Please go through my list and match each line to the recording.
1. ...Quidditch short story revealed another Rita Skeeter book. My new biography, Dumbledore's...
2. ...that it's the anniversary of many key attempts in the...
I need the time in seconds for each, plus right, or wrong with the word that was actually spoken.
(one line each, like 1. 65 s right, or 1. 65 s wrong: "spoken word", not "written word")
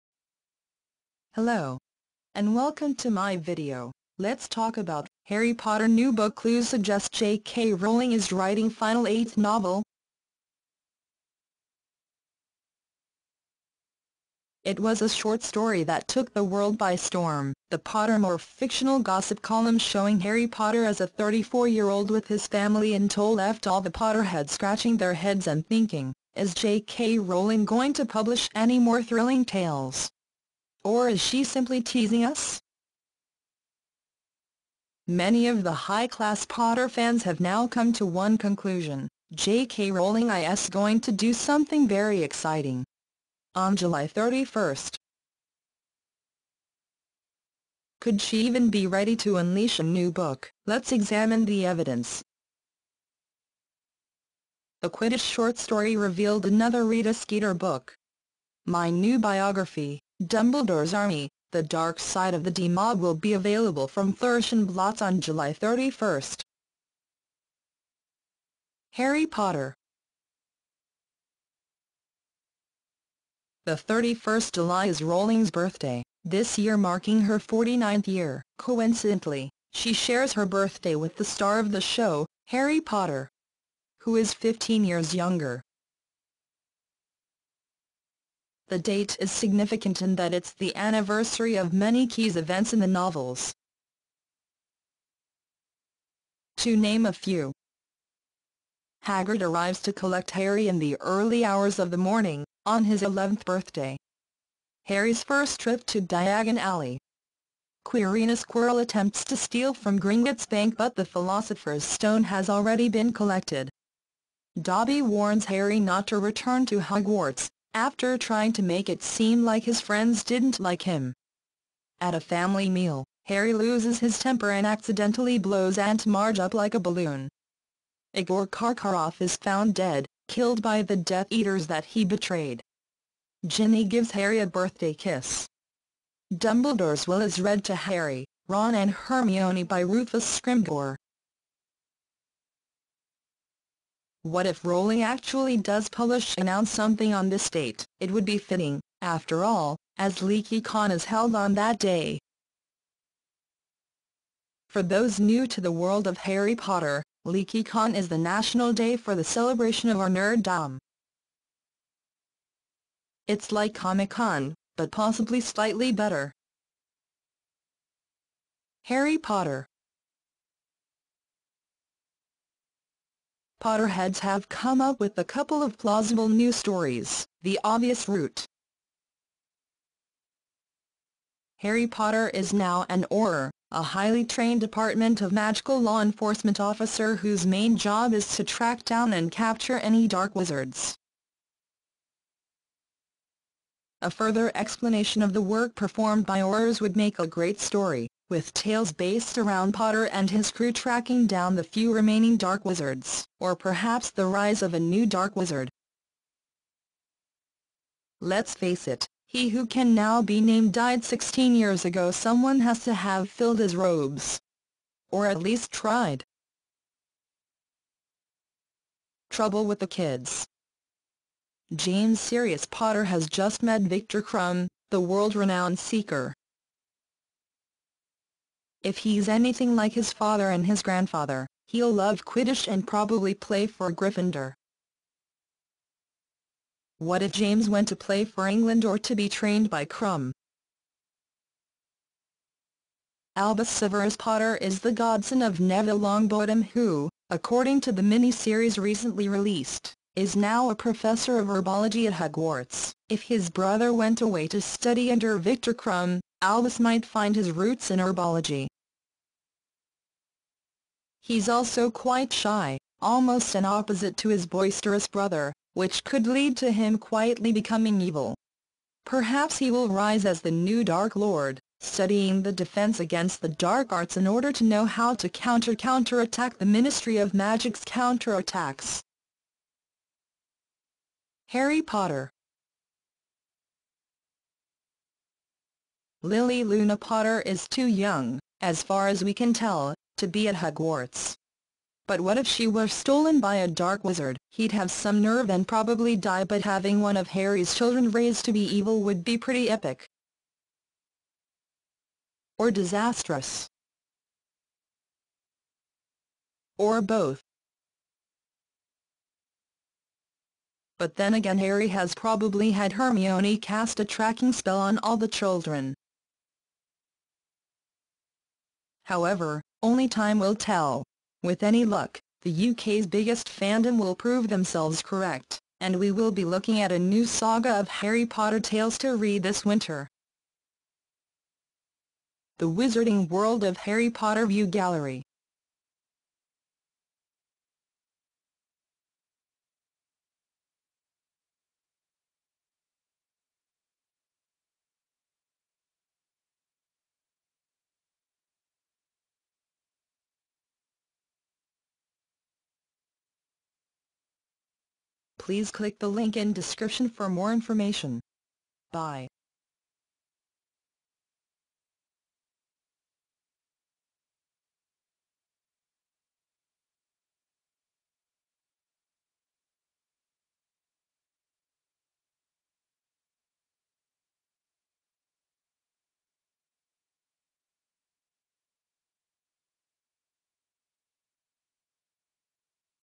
1. 54 s right
2. 90 s wrong: "events", not "attempts".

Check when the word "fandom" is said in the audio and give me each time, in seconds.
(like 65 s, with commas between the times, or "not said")
323 s.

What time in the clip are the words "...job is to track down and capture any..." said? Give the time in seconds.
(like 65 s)
187 s.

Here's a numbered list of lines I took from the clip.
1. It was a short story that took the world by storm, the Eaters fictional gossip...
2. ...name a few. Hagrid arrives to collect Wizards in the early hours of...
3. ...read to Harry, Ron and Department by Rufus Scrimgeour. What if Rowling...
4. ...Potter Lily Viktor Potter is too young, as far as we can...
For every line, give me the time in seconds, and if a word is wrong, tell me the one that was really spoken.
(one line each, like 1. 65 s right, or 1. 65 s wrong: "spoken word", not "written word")
1. 14 s wrong: "Pottermore", not "Eaters"
2. 96 s wrong: "Harry", not "Wizards"
3. 137 s wrong: "Hermione", not "Department"
4. 281 s wrong: "Luna", not "Viktor".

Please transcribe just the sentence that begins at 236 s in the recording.
What if James went to play for England or to be trained by Krum?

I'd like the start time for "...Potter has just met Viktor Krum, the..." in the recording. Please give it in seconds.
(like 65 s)
222 s.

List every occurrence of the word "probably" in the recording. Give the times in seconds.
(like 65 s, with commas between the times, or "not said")
232 s, 295 s, 312 s.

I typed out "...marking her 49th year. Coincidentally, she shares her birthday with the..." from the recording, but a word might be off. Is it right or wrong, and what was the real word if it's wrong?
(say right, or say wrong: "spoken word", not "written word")
right.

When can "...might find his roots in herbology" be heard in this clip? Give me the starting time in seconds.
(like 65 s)
256 s.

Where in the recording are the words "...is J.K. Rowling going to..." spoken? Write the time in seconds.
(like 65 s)
26 s.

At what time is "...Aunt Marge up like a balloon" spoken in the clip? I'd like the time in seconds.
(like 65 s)
125 s.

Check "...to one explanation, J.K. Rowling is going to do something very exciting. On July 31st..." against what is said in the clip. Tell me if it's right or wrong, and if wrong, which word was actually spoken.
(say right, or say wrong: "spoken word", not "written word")
wrong: "conclusion", not "explanation".